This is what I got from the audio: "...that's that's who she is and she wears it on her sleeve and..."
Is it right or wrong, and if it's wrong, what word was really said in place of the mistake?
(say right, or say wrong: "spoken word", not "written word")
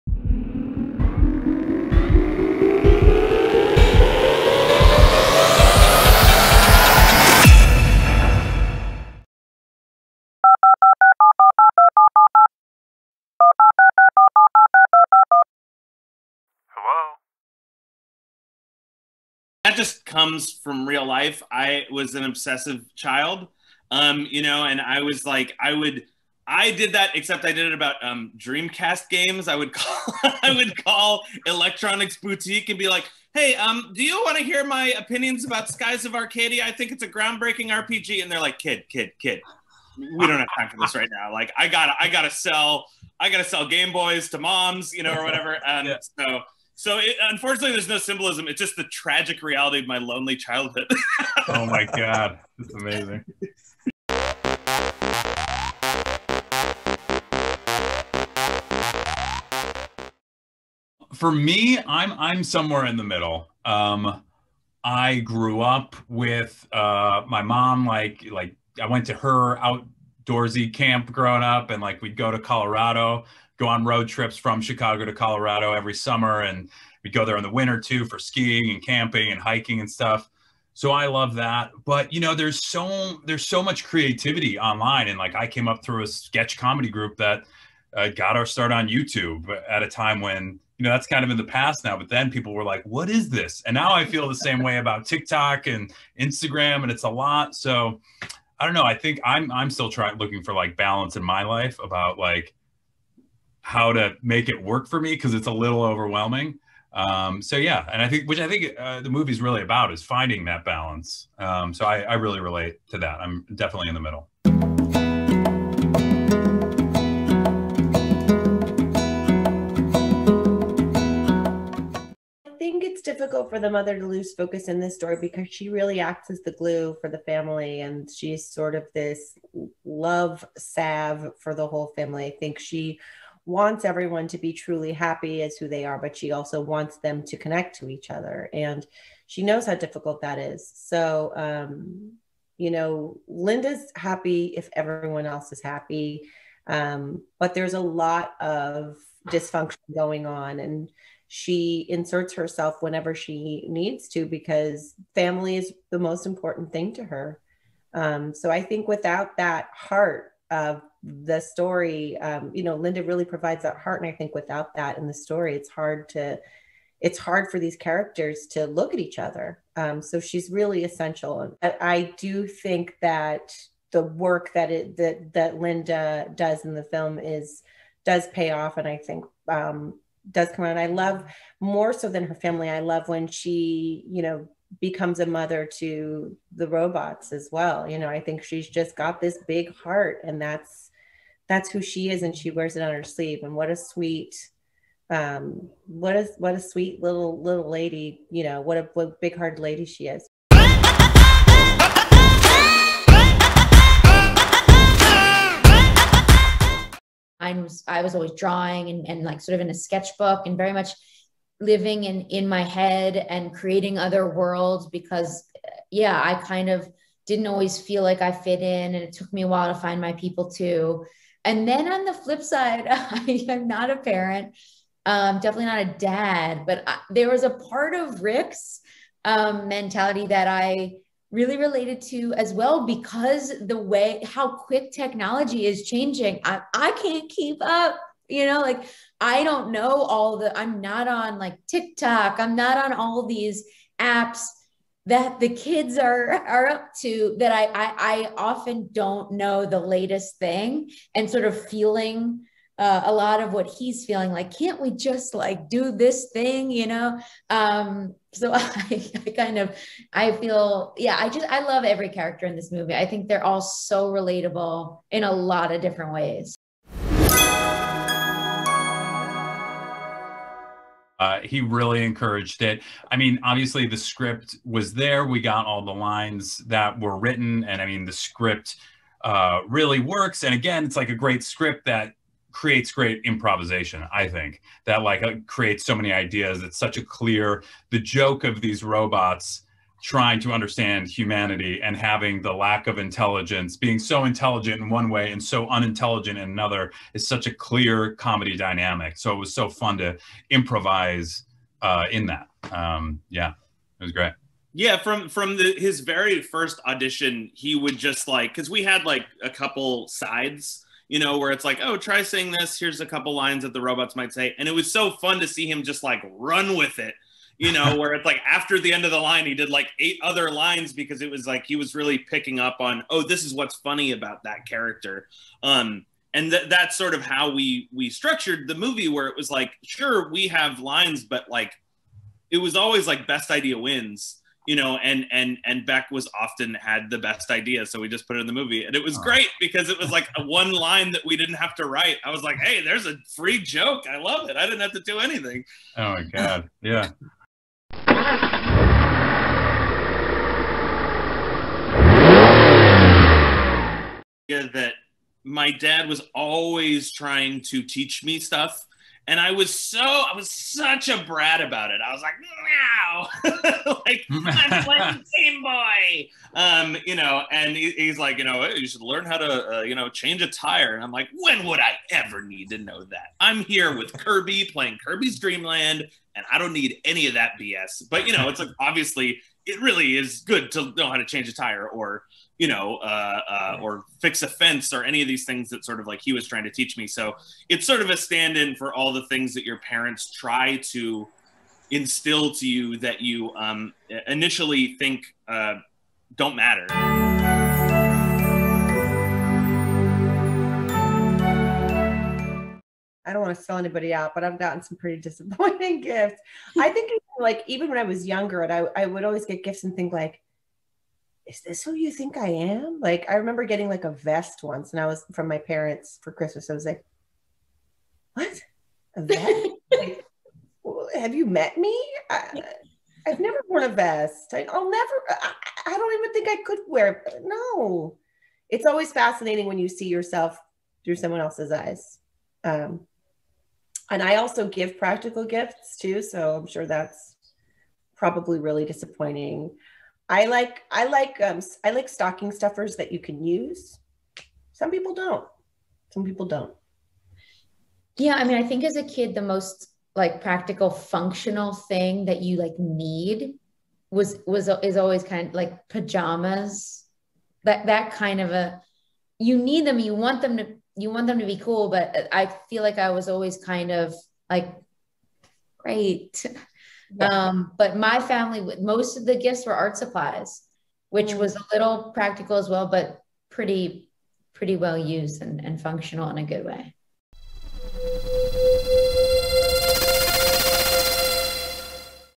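right.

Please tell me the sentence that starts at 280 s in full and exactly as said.
And again, it's like a great script that creates great improvisation.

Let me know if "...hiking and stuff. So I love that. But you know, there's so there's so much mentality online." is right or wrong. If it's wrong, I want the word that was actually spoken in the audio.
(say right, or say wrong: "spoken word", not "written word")
wrong: "creativity", not "mentality".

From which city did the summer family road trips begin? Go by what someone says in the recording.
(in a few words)
Chicago.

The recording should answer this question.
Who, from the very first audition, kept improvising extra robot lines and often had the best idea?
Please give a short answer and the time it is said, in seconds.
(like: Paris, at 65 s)
Beck, at 335 s.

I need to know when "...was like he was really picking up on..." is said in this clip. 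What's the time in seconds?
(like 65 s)
321 s.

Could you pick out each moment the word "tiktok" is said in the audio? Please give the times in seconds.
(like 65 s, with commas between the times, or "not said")
95 s, 241 s.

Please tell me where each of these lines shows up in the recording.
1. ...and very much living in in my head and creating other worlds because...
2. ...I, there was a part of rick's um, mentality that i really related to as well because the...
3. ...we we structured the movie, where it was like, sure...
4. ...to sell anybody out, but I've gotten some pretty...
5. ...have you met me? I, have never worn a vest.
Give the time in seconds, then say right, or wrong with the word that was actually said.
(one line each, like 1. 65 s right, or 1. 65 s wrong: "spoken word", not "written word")
1. 210 s right
2. 226 s right
3. 327 s right
4. 403 s right
5. 421 s right.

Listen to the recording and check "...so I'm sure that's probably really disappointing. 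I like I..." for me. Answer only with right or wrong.
right.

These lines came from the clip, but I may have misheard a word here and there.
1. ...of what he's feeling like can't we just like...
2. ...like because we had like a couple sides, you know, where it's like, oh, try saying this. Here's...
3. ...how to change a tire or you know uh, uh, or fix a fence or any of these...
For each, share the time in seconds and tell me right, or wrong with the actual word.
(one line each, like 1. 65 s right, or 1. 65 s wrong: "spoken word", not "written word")
1. 253 s right
2. 308 s right
3. 381 s right.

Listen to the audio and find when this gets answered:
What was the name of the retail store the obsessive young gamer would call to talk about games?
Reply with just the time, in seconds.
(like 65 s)
31 s.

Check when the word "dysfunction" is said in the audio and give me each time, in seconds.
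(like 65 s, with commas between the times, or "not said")
149 s.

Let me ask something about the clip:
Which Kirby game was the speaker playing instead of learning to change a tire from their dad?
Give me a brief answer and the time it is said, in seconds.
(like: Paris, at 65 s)
Kirby's Dream Land, at 375 s.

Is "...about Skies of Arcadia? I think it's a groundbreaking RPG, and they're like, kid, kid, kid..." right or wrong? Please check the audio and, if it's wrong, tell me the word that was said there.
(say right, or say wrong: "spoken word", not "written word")
right.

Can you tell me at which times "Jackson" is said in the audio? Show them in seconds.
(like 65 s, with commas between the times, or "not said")
not said.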